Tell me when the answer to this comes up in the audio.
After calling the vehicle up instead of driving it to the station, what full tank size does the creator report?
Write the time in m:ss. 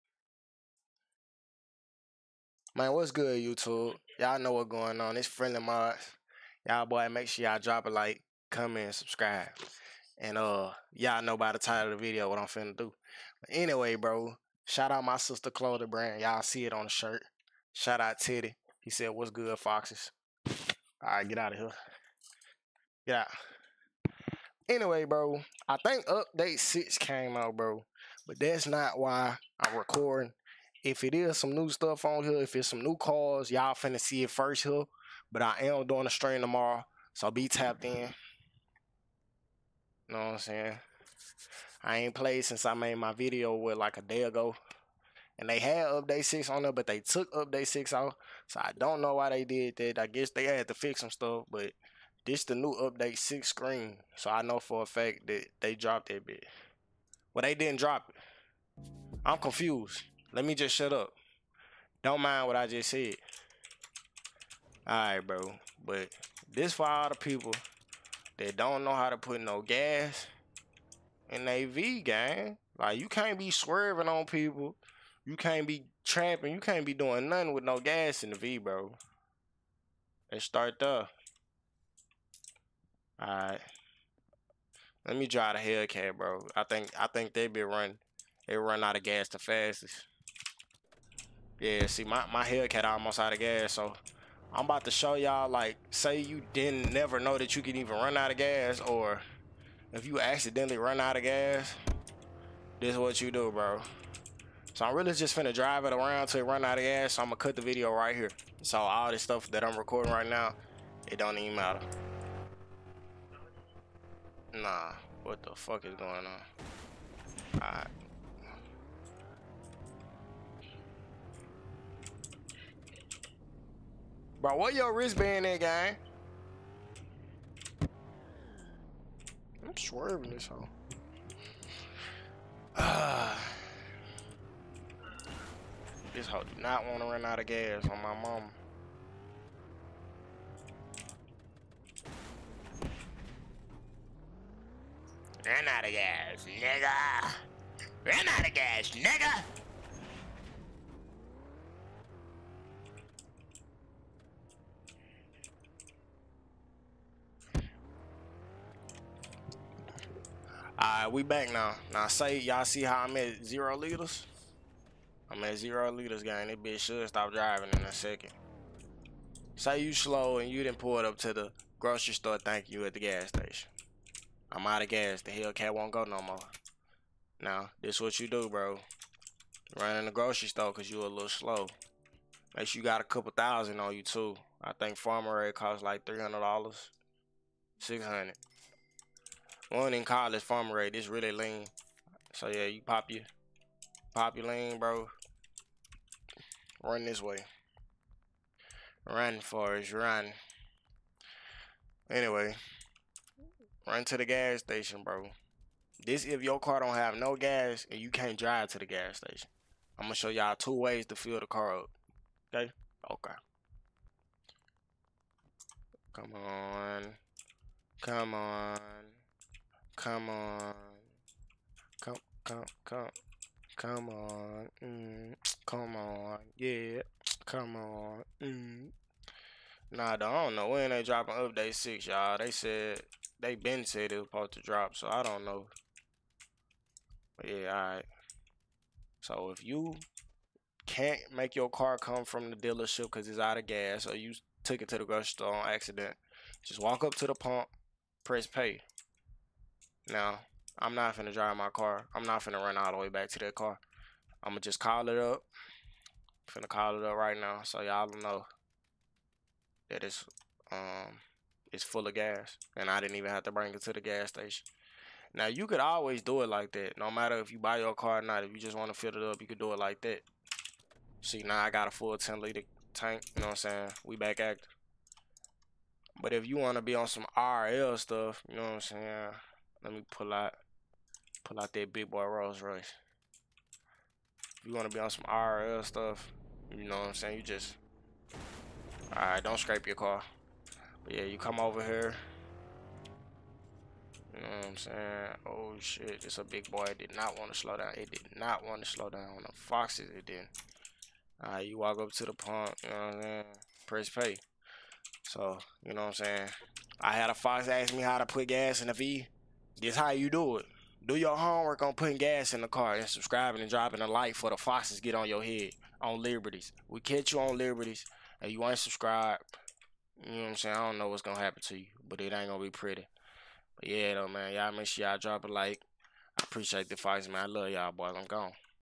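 4:32.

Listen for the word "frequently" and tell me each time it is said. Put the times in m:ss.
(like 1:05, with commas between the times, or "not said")
not said.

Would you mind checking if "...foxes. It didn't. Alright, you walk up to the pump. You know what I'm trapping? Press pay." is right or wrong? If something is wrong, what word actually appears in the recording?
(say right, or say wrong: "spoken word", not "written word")
wrong: "saying", not "trapping".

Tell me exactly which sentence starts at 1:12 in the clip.
Like you can't be swerving on people.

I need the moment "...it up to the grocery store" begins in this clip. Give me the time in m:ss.
2:50.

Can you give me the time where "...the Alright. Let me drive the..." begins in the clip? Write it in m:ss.
1:20.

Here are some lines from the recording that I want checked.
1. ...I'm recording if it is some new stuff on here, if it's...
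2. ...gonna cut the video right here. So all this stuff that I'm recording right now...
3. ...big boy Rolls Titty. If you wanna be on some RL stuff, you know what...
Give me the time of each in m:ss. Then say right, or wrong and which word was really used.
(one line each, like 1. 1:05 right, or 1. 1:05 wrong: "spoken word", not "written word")
1. 0:29 right
2. 1:47 right
3. 4:41 wrong: "Royce", not "Titty".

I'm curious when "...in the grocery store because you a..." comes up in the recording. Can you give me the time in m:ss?
2:59.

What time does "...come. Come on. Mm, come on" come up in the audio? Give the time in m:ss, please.
3:42.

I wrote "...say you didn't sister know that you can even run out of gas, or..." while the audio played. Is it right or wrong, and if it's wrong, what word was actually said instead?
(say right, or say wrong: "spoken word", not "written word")
wrong: "never", not "sister".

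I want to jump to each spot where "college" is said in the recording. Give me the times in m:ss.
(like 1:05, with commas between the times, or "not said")
3:10.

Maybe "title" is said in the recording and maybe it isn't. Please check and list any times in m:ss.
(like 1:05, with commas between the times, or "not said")
0:11.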